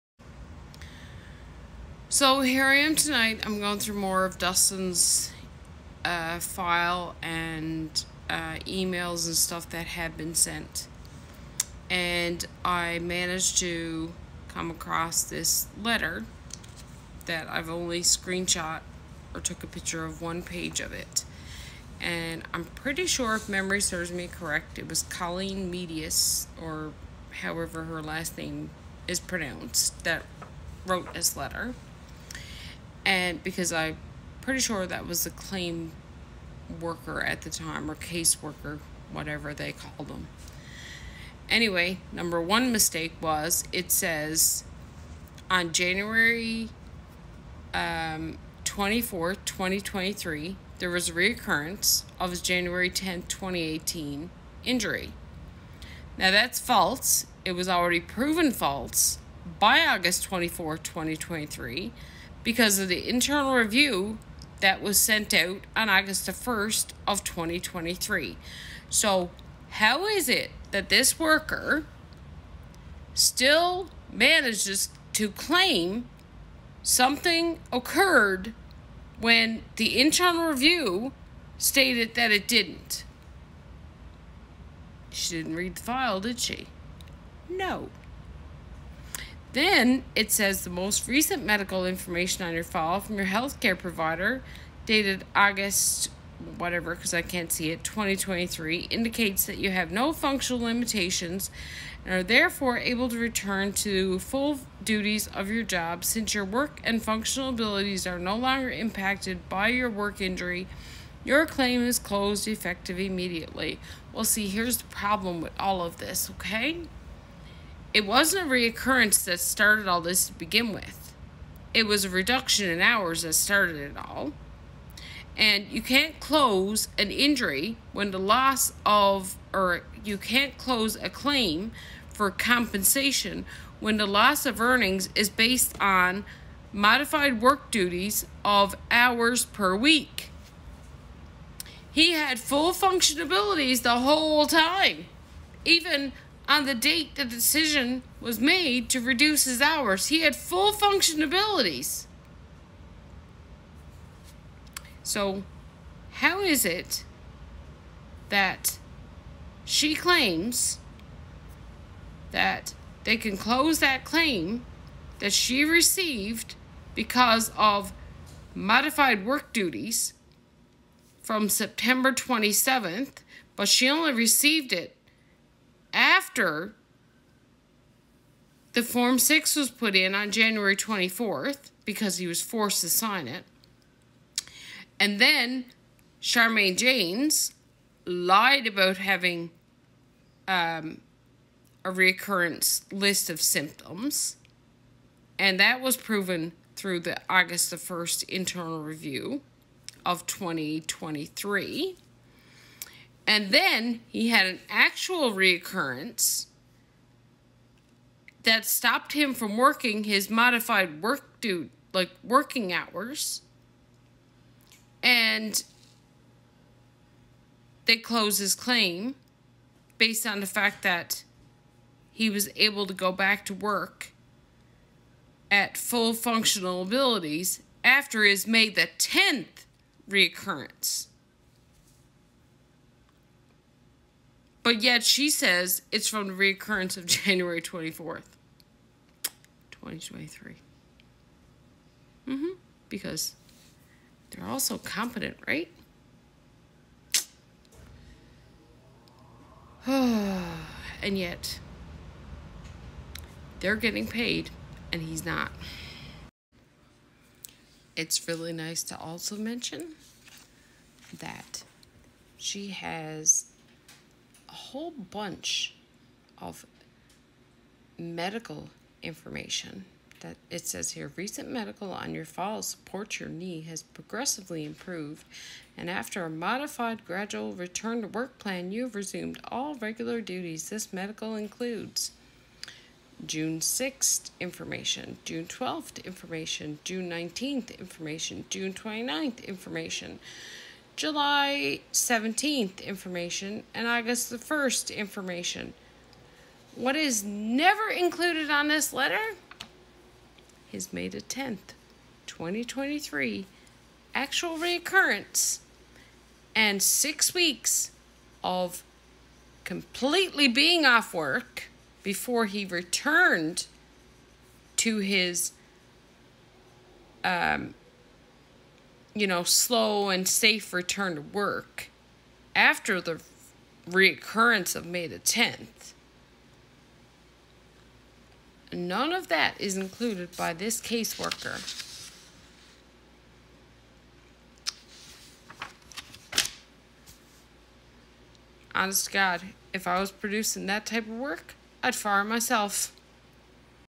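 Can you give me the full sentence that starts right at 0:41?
Anyway, number one mistake was it says on January um, 2023, there was a reoccurrence of his January 10th, 2018 injury.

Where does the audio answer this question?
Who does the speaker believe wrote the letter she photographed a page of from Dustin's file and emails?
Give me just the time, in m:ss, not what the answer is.
0:25.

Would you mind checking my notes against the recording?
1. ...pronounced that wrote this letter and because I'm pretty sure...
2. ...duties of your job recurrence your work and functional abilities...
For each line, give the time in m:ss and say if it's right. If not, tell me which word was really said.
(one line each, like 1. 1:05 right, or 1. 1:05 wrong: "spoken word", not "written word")
1. 0:29 right
2. 1:44 wrong: "since", not "recurrence".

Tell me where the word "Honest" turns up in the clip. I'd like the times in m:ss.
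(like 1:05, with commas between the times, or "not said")
5:38.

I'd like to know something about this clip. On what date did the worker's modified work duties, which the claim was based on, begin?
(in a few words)
September 27.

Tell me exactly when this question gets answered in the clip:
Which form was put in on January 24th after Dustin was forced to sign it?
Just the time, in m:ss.
2:58.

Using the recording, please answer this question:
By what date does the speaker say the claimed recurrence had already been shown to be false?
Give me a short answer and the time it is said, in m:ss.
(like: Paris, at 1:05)
August 24, 2023, at 0:59.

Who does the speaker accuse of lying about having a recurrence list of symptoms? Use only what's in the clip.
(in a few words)
Charmaine Janes.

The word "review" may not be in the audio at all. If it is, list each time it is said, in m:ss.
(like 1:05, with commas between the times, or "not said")
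1:03, 1:20, 3:18.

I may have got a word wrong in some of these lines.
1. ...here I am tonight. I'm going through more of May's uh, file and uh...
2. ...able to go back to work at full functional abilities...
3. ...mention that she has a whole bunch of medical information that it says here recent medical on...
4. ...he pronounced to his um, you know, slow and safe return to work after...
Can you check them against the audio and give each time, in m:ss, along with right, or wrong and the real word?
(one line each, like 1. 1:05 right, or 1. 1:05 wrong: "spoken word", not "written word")
1. 0:02 wrong: "Dustin", not "May"
2. 3:42 right
3. 4:19 right
4. 5:12 wrong: "returned", not "pronounced".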